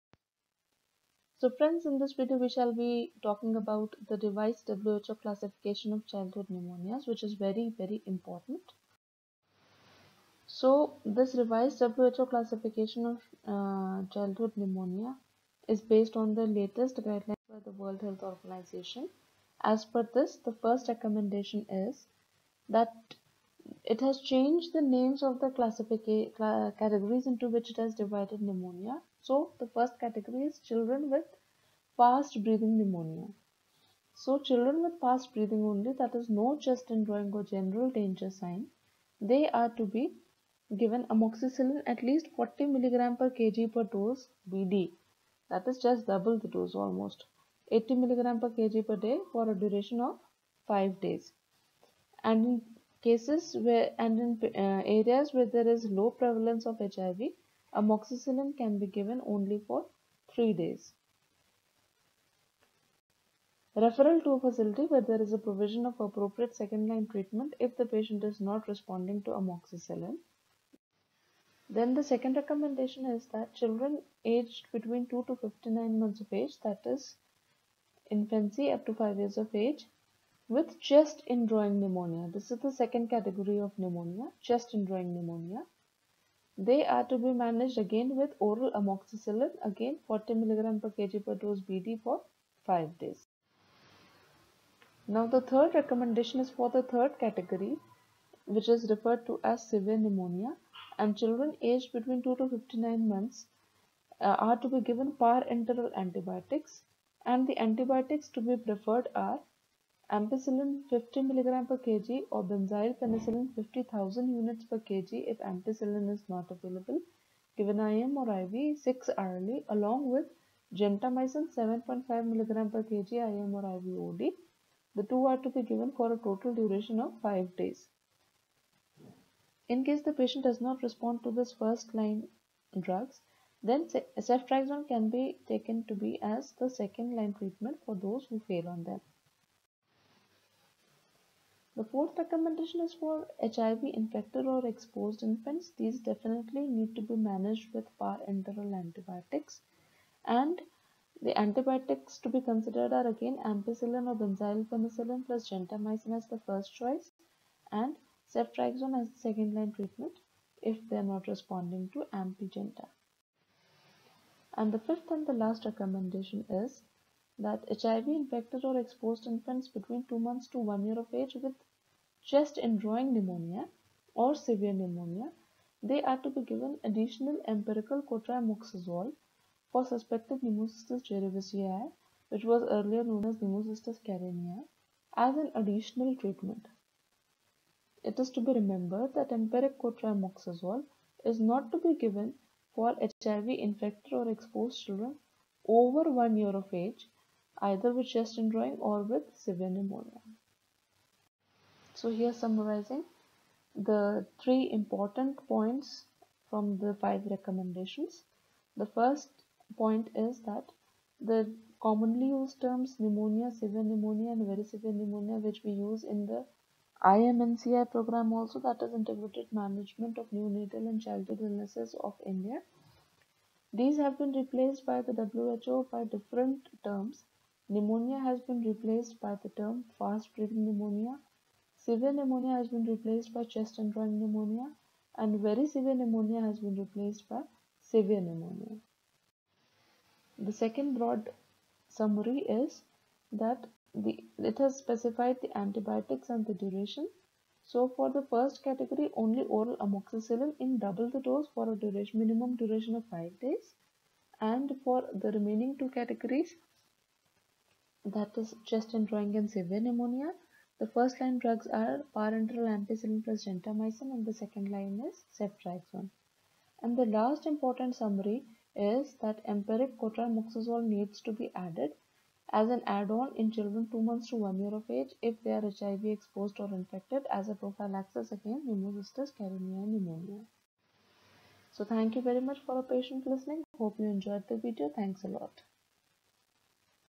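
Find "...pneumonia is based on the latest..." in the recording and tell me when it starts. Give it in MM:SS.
00:14.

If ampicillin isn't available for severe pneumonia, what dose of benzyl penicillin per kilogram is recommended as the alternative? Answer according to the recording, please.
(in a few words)
50,000 units per kg.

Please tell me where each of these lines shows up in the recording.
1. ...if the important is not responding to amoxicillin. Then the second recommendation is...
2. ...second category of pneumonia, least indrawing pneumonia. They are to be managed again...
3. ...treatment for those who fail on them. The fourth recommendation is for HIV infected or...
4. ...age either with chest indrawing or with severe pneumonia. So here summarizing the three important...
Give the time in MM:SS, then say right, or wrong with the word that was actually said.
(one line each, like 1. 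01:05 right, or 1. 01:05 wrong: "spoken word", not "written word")
1. 01:07 wrong: "patient", not "important"
2. 01:22 wrong: "chest", not "least"
3. 02:17 right
4. 03:16 right.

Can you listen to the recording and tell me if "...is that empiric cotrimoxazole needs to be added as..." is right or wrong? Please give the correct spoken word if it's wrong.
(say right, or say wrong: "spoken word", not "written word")
right.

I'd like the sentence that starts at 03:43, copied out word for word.
These have been replaced by the WHO by different terms Pneumonia has been replaced by the term fast breathing pneumonia.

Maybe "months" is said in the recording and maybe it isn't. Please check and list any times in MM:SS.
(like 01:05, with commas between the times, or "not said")
01:15, 01:43, 02:50, 04:34.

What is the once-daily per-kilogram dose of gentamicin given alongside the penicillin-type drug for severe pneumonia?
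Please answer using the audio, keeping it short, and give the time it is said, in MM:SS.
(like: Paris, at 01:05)
7.5 mg per kg, at 02:01.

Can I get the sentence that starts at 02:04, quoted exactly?
The two are to be given for a total duration of 5 days.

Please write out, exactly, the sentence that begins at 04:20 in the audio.
The first line drugs are parenteral ampicillin plus gentamicin and the second line is ceftriaxone.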